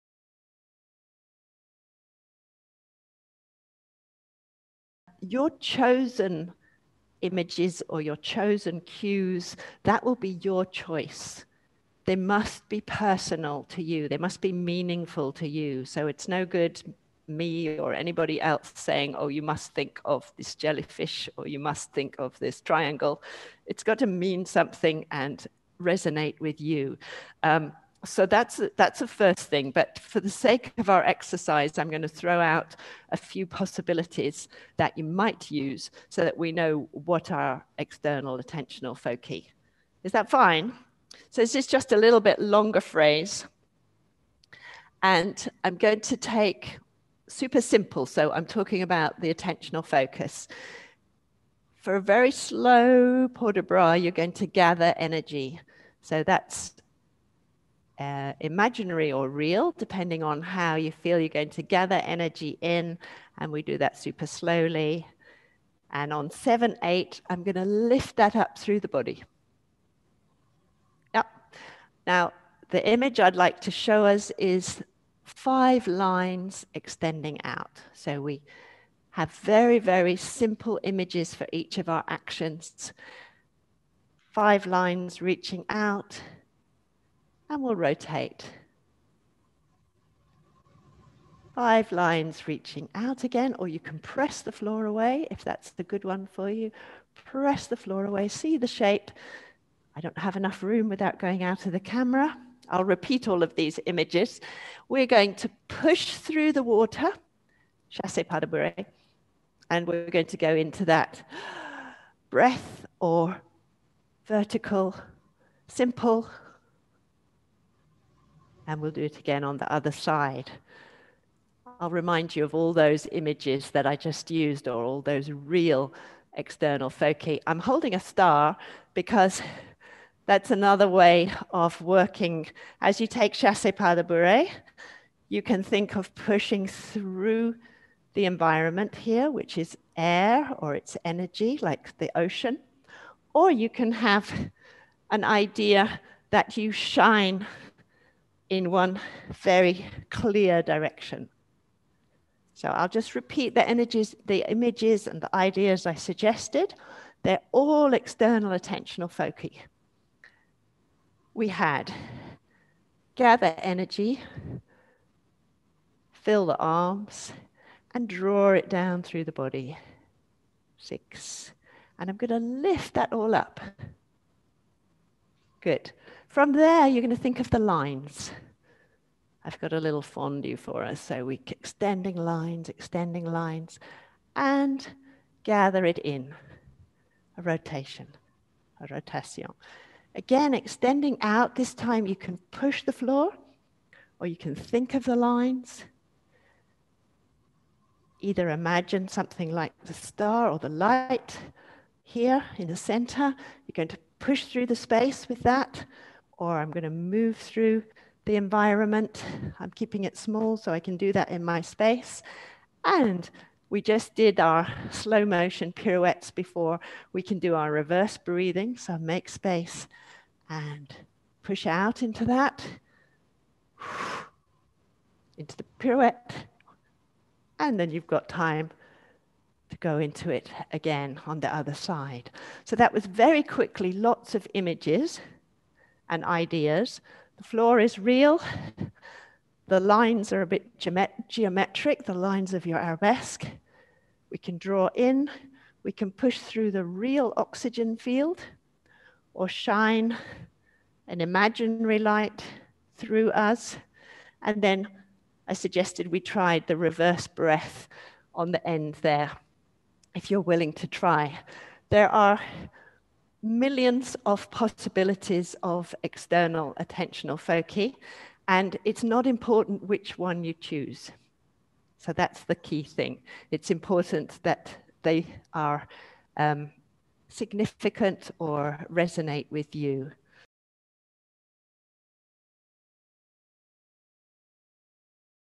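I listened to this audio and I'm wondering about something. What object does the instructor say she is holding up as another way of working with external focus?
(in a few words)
A star.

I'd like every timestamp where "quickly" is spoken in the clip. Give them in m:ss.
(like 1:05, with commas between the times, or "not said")
3:53.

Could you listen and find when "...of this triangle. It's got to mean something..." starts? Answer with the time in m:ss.
0:22.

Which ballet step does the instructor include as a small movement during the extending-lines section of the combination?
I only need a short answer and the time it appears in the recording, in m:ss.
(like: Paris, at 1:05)
Fondu, at 2:59.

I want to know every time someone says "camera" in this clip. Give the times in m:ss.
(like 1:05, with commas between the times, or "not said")
1:41.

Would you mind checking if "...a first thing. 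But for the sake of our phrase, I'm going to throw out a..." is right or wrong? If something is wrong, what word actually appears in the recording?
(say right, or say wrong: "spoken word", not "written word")
wrong: "exercise", not "phrase".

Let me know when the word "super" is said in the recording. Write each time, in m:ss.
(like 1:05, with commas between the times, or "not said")
0:47, 1:03.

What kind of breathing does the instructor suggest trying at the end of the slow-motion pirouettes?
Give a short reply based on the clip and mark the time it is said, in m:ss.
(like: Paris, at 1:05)
Reverse breathing, at 3:37.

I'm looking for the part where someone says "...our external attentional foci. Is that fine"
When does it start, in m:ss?
0:37.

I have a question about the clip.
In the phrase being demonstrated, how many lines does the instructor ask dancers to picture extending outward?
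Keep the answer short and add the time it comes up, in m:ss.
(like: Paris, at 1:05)
5, at 1:15.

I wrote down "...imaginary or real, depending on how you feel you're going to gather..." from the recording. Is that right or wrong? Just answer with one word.
right.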